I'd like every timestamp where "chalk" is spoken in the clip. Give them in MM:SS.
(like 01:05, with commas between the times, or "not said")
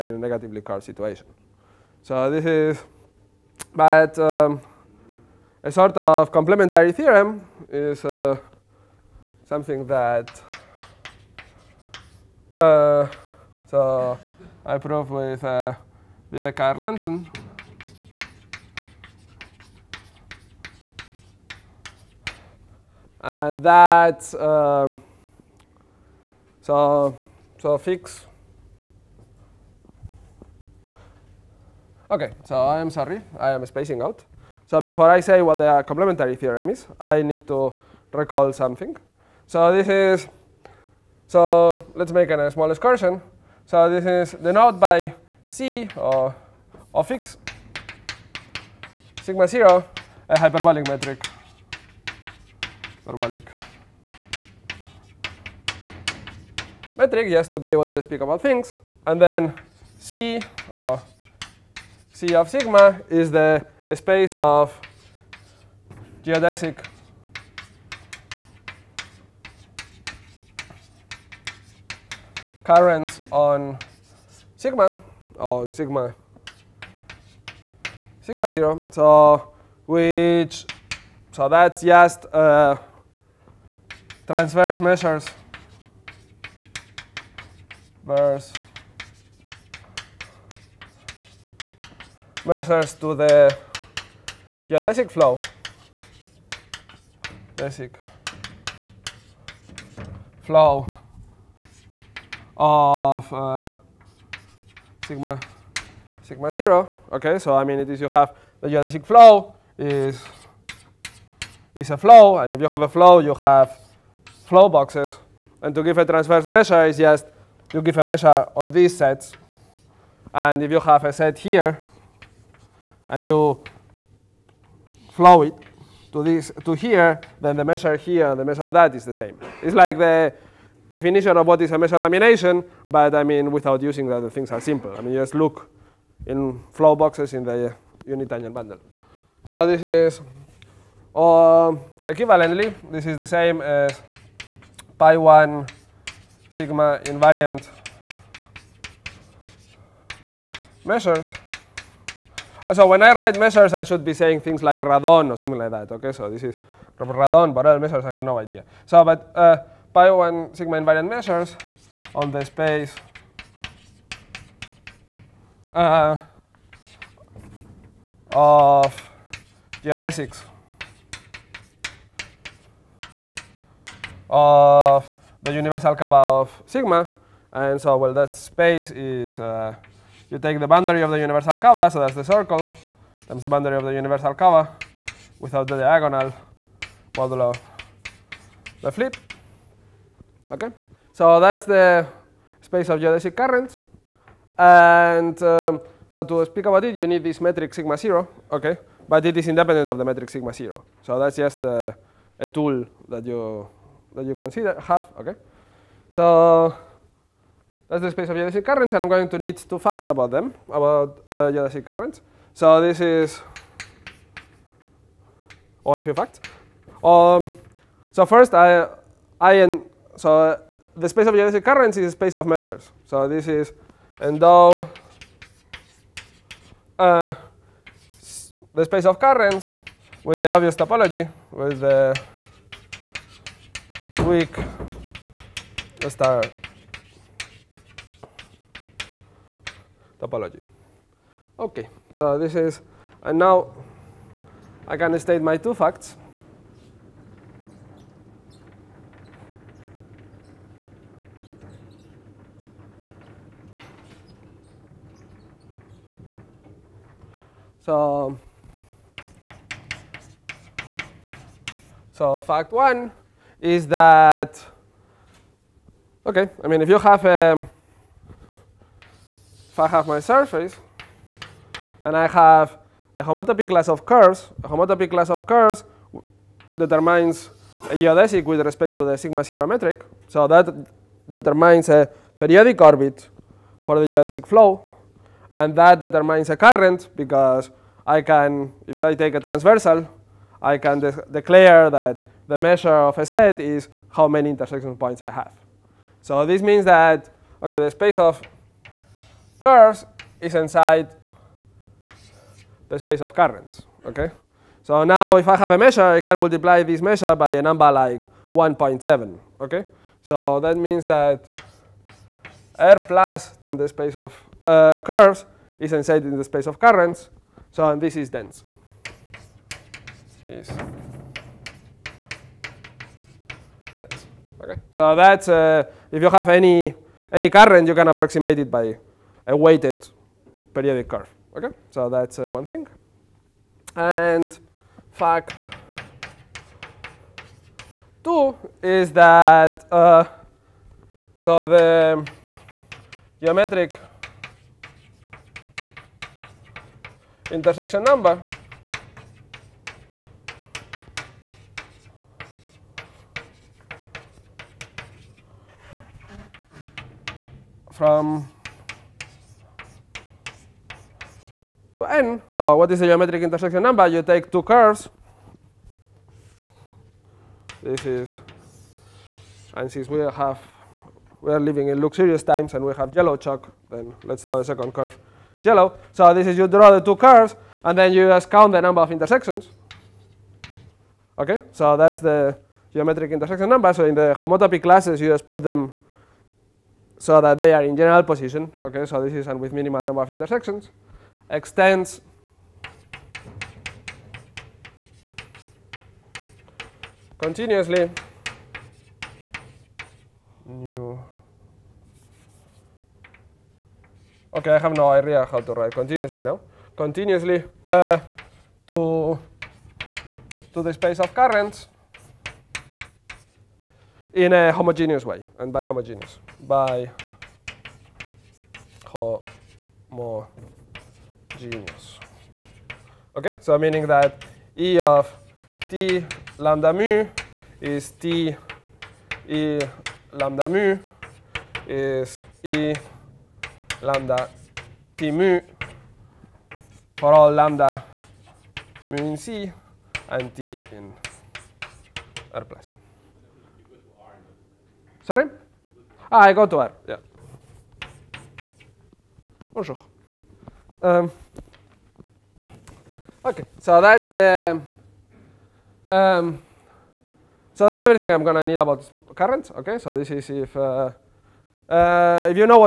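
06:13.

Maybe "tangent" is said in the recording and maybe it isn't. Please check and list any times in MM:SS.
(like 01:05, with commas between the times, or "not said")
02:18.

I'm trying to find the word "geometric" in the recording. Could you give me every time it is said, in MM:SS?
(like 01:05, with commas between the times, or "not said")
05:43, 06:03, 06:22.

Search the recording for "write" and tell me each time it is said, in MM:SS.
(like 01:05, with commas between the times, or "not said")
02:33, 06:45.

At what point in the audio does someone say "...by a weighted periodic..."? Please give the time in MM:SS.
05:28.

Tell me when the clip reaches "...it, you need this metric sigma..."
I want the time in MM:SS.
03:16.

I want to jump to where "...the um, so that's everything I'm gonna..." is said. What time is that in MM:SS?
07:34.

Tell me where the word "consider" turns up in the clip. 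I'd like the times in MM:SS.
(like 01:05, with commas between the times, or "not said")
03:24.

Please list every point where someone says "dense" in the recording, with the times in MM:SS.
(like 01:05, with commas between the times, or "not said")
05:18.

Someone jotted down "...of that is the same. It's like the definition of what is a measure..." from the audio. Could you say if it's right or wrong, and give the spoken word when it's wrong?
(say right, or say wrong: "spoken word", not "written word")
right.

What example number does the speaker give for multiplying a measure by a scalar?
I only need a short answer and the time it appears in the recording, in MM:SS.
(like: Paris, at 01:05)
1.7, at 05:08.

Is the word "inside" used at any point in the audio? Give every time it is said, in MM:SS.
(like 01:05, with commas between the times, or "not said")
05:00, 05:15.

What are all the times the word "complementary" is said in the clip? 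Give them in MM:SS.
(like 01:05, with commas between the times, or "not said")
00:06, 00:35.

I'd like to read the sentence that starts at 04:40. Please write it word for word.
So that determines a periodic orbit for the geodesic flow.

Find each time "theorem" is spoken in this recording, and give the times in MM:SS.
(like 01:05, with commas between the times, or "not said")
00:06, 00:36.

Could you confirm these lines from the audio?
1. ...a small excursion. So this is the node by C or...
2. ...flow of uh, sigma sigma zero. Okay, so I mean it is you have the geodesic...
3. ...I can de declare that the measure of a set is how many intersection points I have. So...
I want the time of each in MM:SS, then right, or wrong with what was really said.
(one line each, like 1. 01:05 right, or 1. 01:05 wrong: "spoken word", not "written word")
1. 00:42 right
2. 01:40 right
3. 04:50 right.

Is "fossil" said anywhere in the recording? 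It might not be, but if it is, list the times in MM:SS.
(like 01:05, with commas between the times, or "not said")
not said.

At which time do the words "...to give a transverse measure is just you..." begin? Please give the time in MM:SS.
01:55.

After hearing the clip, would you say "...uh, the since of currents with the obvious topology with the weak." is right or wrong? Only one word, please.
wrong.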